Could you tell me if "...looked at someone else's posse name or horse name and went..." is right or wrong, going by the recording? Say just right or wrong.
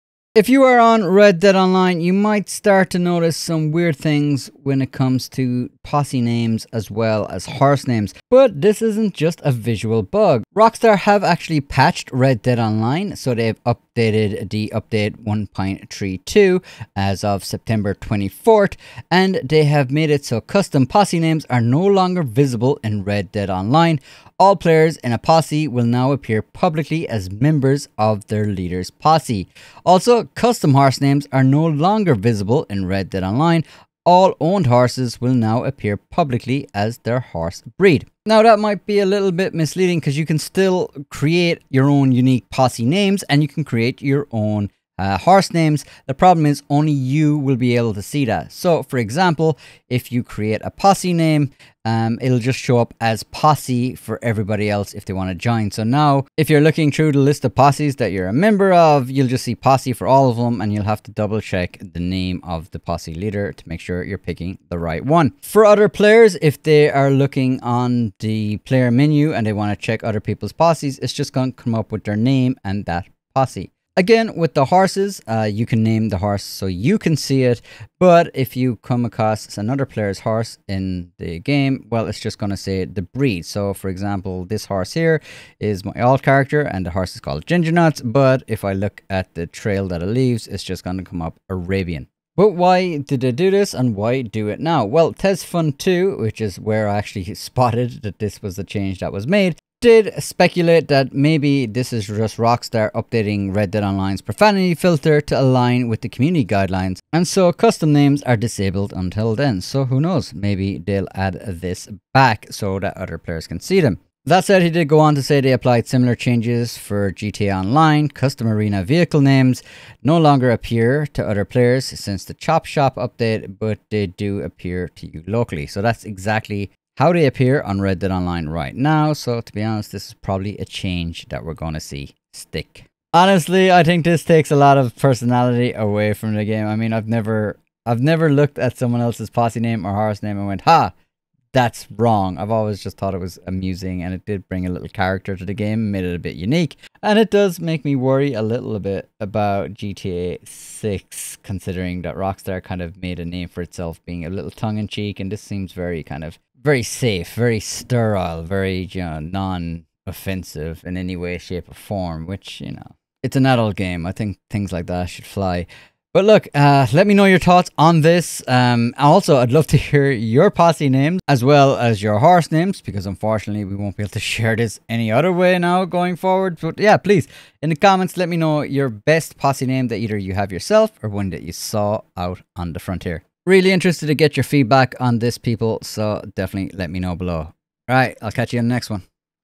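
right.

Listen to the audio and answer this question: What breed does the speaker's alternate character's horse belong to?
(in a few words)
Arabian.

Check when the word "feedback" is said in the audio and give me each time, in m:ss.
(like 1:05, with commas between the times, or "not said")
3:04.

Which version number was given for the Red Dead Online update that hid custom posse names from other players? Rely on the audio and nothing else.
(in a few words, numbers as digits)
1.32.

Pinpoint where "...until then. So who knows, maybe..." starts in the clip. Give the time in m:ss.
1:48.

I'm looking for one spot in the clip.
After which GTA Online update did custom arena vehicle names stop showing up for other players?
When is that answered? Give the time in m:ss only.
2:02.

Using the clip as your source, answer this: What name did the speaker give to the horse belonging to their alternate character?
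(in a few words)
Ginger Nuts.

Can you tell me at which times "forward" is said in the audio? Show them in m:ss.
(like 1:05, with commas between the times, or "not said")
2:56.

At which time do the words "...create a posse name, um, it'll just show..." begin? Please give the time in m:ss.
0:50.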